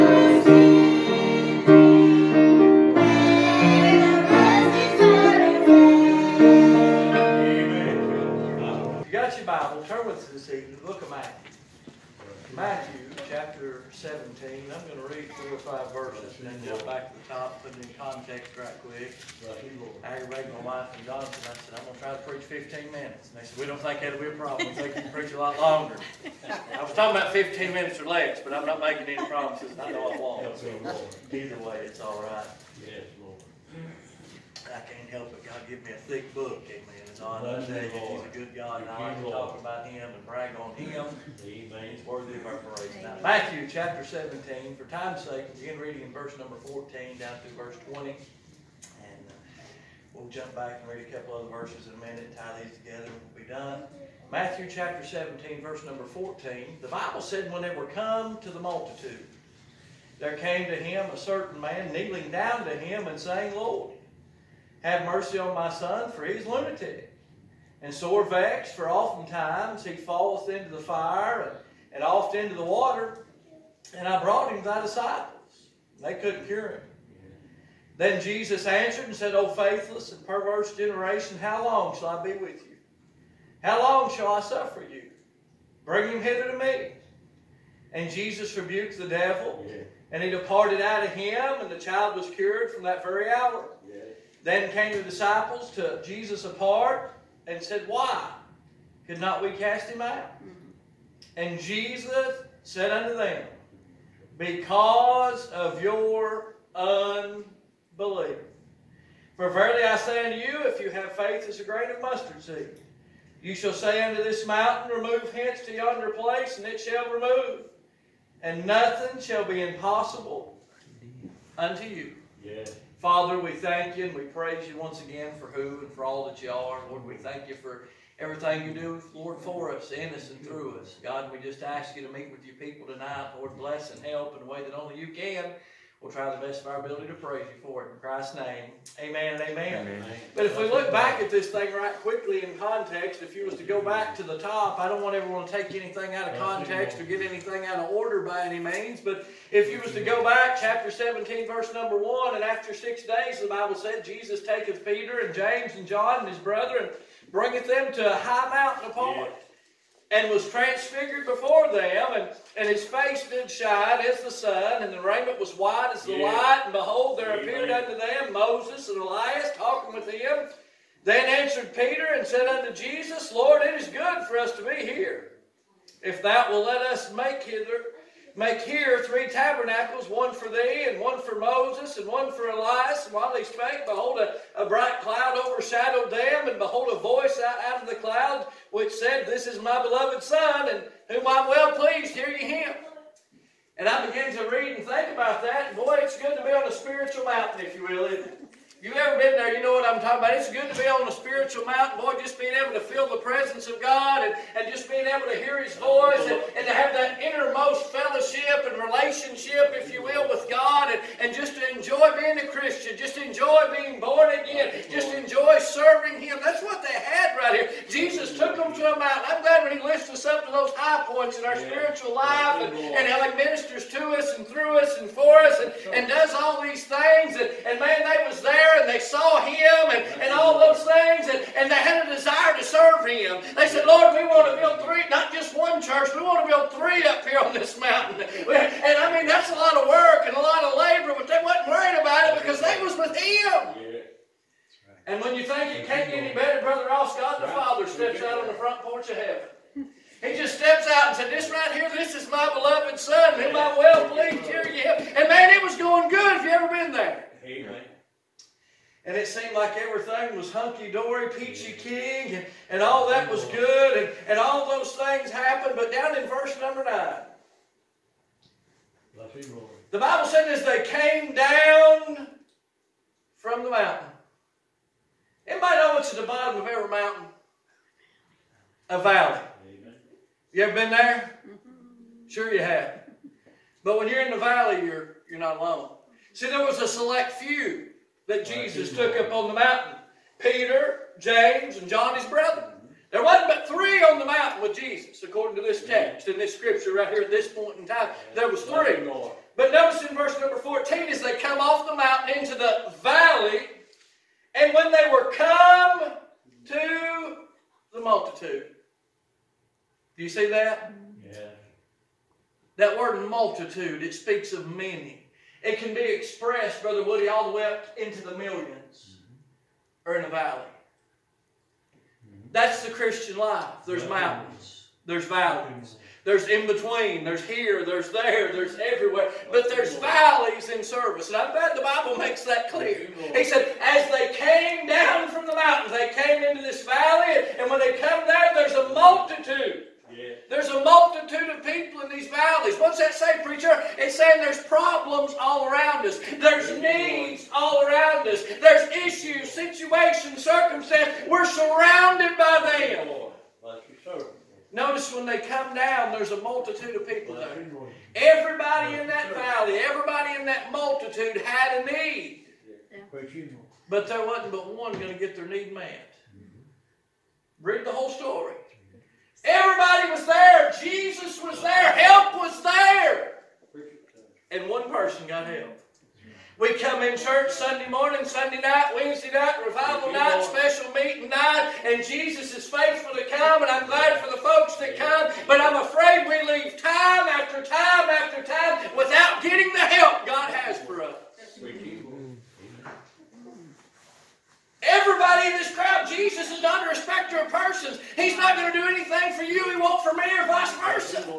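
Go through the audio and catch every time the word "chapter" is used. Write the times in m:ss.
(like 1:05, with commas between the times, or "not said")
0:43, 0:54, 2:30.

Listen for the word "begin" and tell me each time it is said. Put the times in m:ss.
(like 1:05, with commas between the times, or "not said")
0:45, 3:14.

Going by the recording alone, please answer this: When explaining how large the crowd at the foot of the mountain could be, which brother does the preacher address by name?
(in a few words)
Brother Woody.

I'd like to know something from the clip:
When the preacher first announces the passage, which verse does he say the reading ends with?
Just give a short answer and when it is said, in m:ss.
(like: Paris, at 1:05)
20, at 0:47.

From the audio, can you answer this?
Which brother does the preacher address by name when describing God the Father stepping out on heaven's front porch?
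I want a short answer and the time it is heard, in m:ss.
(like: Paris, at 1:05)
Brother Ross, at 4:06.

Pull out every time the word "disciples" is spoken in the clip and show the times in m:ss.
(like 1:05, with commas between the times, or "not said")
1:14, 1:35.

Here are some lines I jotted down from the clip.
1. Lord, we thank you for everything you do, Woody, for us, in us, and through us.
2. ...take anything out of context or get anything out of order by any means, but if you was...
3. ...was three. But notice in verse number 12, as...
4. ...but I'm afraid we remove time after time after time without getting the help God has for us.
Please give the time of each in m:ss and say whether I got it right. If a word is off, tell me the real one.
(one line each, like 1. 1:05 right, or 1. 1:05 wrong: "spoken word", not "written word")
1. 2:06 wrong: "Lord", not "Woody"
2. 2:25 right
3. 4:58 wrong: "14", not "12"
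4. 6:25 wrong: "leave", not "remove".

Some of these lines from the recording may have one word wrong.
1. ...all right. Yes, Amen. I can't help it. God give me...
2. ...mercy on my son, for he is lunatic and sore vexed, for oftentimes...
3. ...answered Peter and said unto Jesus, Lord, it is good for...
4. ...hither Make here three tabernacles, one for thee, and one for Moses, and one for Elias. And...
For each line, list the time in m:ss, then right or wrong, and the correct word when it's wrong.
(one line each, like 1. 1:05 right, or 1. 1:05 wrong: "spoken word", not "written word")
1. 0:31 wrong: "Lord", not "Amen"
2. 1:05 right
3. 2:51 right
4. 2:57 right.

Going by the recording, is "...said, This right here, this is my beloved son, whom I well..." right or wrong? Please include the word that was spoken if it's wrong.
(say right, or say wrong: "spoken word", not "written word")
right.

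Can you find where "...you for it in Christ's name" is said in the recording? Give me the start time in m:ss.
2:17.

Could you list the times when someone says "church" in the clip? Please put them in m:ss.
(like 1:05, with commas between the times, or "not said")
3:55, 6:17.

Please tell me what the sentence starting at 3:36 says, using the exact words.
That's what they had right here.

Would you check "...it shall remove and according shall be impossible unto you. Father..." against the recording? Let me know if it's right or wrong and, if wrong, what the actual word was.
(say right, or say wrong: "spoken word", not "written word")
wrong: "nothing", not "according".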